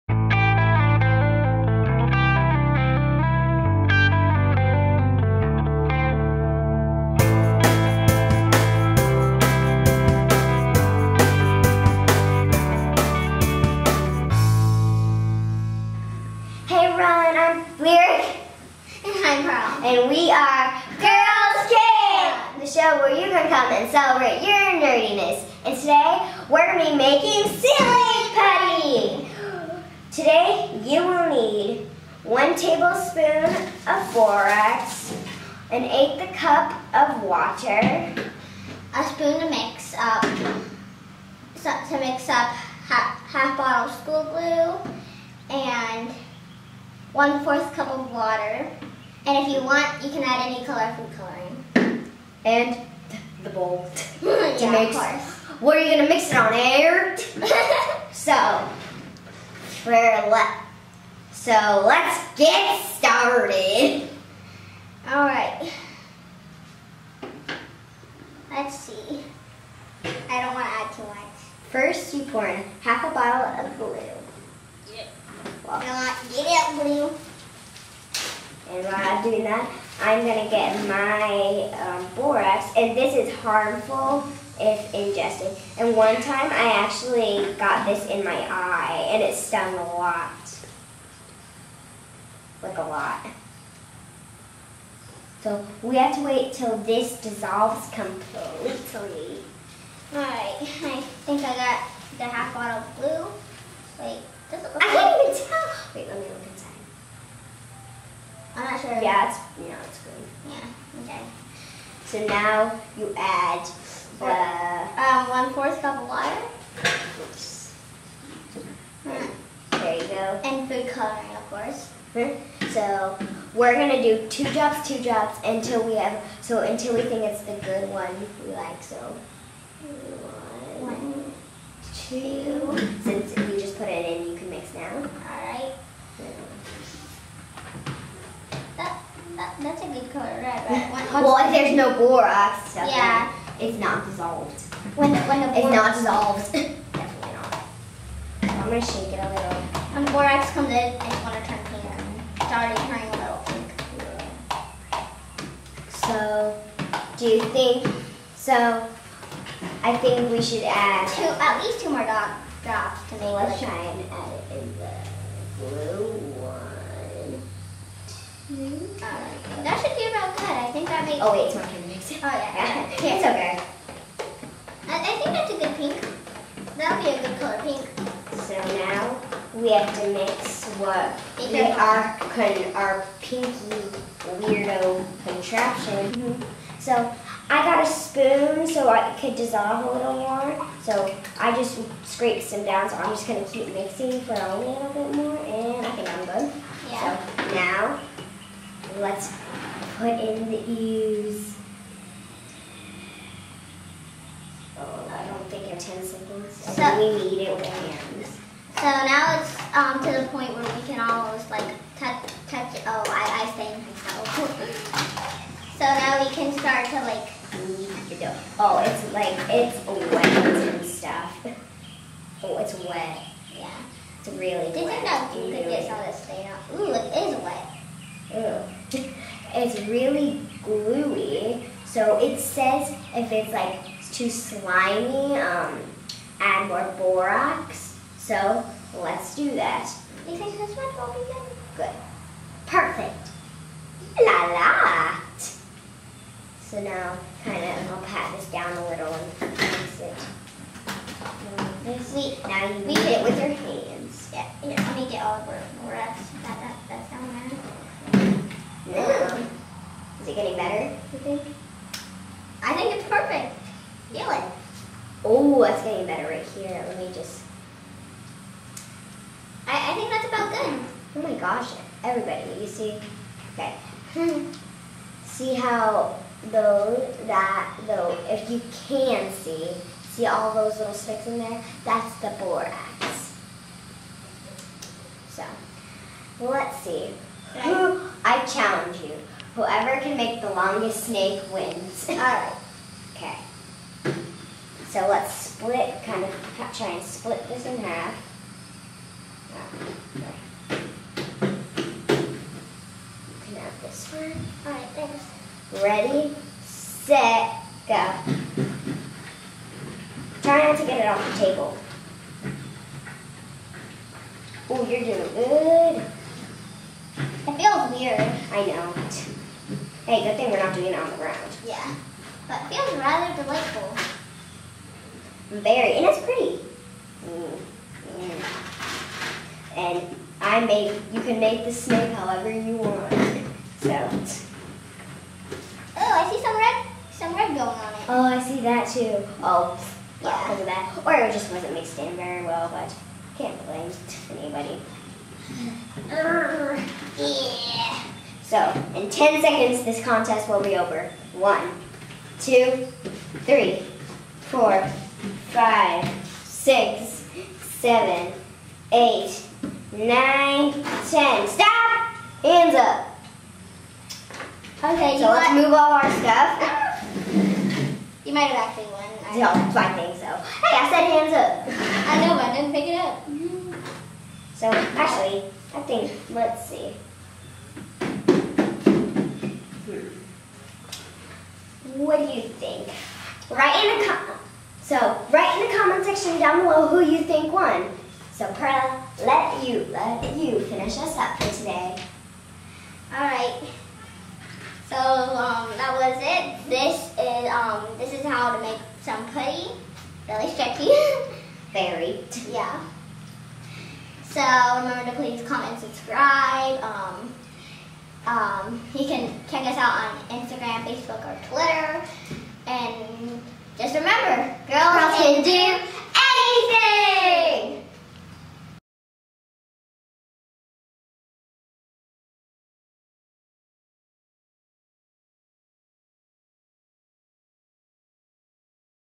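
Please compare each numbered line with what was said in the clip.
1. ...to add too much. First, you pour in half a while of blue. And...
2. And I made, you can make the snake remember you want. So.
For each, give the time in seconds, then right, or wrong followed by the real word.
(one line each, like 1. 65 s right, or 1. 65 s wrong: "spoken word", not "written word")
1. 70 s wrong: "bottle", not "while"
2. 329 s wrong: "however", not "remember".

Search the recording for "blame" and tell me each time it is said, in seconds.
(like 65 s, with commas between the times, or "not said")
343 s.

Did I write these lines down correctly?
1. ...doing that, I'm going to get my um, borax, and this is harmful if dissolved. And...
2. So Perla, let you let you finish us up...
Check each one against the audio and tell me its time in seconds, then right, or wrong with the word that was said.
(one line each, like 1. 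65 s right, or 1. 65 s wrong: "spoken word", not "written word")
1. 79 s wrong: "ingested", not "dissolved"
2. 388 s right.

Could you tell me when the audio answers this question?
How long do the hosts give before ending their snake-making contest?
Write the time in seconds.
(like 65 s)
349 s.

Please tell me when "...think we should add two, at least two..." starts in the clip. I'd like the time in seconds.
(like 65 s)
159 s.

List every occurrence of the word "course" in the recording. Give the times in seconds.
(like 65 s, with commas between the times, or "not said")
55 s, 121 s.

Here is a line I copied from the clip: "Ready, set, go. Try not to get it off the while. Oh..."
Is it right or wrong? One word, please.
wrong.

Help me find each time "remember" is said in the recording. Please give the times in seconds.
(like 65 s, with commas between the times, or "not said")
404 s, 413 s.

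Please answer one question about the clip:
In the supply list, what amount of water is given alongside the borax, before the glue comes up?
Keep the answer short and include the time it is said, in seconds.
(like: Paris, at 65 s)
1/8 cup, at 35 s.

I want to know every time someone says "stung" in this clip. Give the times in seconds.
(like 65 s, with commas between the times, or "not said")
89 s.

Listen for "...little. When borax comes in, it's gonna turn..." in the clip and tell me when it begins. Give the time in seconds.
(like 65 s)
149 s.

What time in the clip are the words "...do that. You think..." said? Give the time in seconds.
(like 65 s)
239 s.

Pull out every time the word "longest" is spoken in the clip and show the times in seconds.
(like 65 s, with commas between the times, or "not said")
290 s.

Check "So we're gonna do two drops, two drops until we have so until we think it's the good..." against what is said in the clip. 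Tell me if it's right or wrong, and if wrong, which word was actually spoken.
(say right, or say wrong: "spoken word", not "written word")
right.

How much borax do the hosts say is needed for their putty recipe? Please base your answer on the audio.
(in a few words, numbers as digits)
1 tablespoon.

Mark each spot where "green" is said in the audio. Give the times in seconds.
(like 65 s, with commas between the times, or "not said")
110 s.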